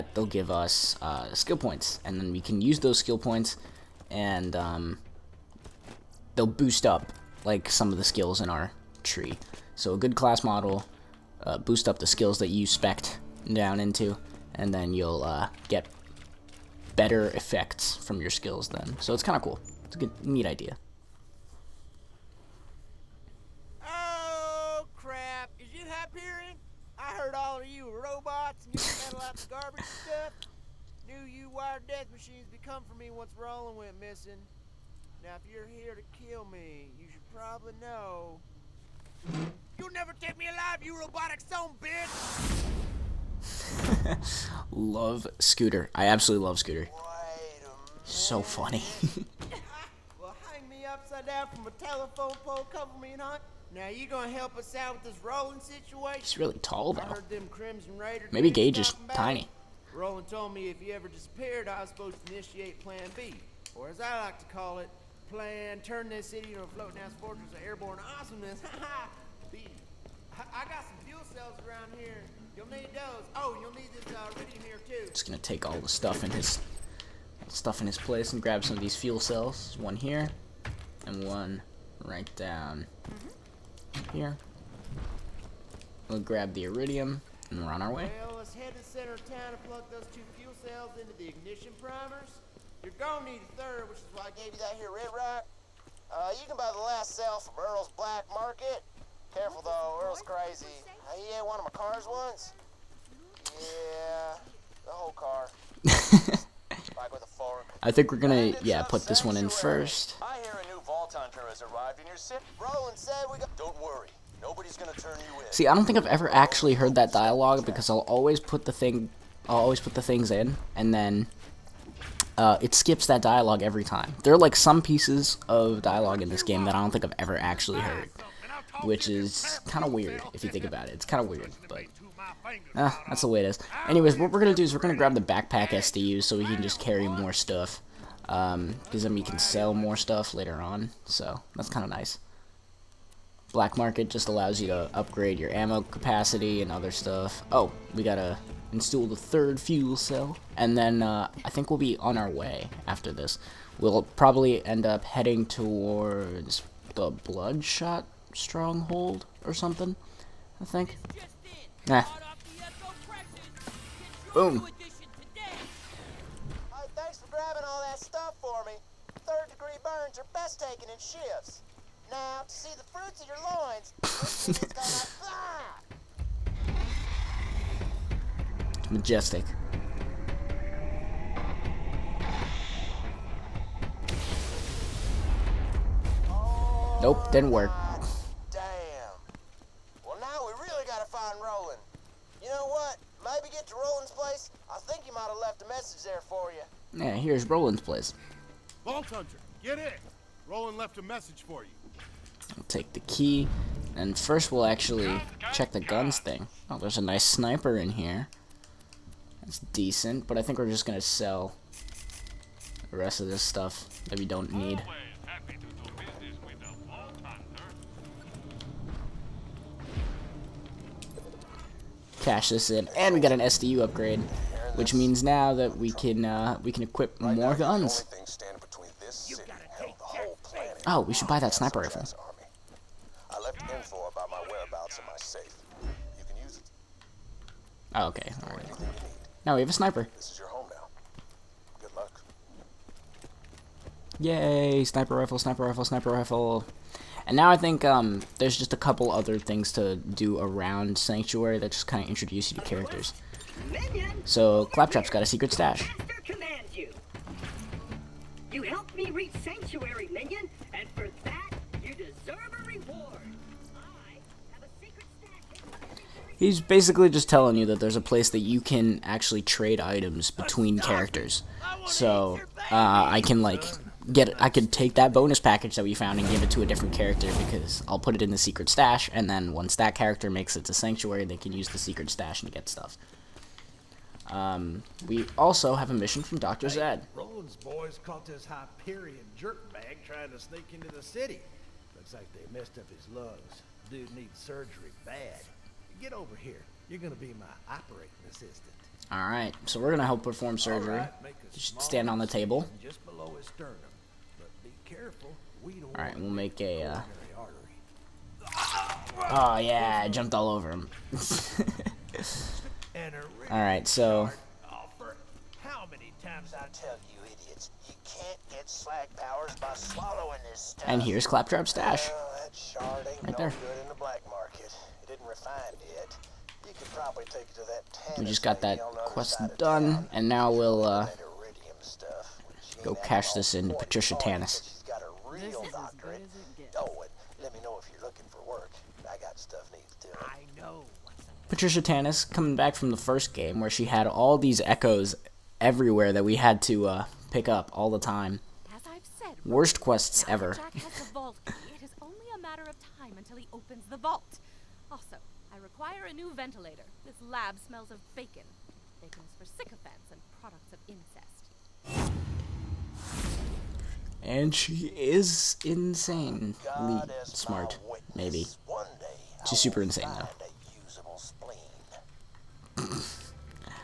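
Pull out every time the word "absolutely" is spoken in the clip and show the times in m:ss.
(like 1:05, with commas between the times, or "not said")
0:46.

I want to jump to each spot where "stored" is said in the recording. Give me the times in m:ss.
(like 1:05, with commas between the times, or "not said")
not said.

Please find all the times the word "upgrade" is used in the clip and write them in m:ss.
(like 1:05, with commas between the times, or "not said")
2:24, 3:43.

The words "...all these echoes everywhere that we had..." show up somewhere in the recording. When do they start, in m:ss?
5:44.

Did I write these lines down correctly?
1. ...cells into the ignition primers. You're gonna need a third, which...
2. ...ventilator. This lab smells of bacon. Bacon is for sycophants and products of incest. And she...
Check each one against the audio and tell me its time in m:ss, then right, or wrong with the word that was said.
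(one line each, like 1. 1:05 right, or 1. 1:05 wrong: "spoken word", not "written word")
1. 1:30 right
2. 5:56 right.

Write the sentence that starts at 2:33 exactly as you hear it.
We'll probably end up heading towards the Bloodshot Stronghold or something, I think.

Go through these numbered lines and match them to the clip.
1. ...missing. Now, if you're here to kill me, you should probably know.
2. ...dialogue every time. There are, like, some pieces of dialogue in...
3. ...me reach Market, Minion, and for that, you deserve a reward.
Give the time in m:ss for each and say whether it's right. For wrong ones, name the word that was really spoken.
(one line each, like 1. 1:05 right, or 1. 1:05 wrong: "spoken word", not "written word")
1. 0:33 right
2. 2:03 right
3. 4:18 wrong: "Sanctuary", not "Market".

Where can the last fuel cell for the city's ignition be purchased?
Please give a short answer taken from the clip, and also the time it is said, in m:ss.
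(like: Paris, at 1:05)
Earl's Black Market, at 1:37.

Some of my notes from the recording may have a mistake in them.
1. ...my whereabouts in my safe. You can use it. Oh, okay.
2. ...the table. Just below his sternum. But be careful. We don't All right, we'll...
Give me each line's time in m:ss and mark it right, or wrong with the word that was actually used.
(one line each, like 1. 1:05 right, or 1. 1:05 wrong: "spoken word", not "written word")
1. 3:54 right
2. 5:02 right.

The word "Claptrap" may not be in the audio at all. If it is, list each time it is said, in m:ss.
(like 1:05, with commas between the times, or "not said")
4:14, 5:21.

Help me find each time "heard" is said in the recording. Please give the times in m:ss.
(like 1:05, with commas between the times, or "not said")
1:56, 2:07.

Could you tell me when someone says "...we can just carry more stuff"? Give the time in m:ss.
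2:16.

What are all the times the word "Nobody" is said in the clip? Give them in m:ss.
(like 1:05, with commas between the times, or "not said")
1:54.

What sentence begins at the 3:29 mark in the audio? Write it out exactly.
That's decent, but I think we're just gonna sell the rest of this stuff that we don't need.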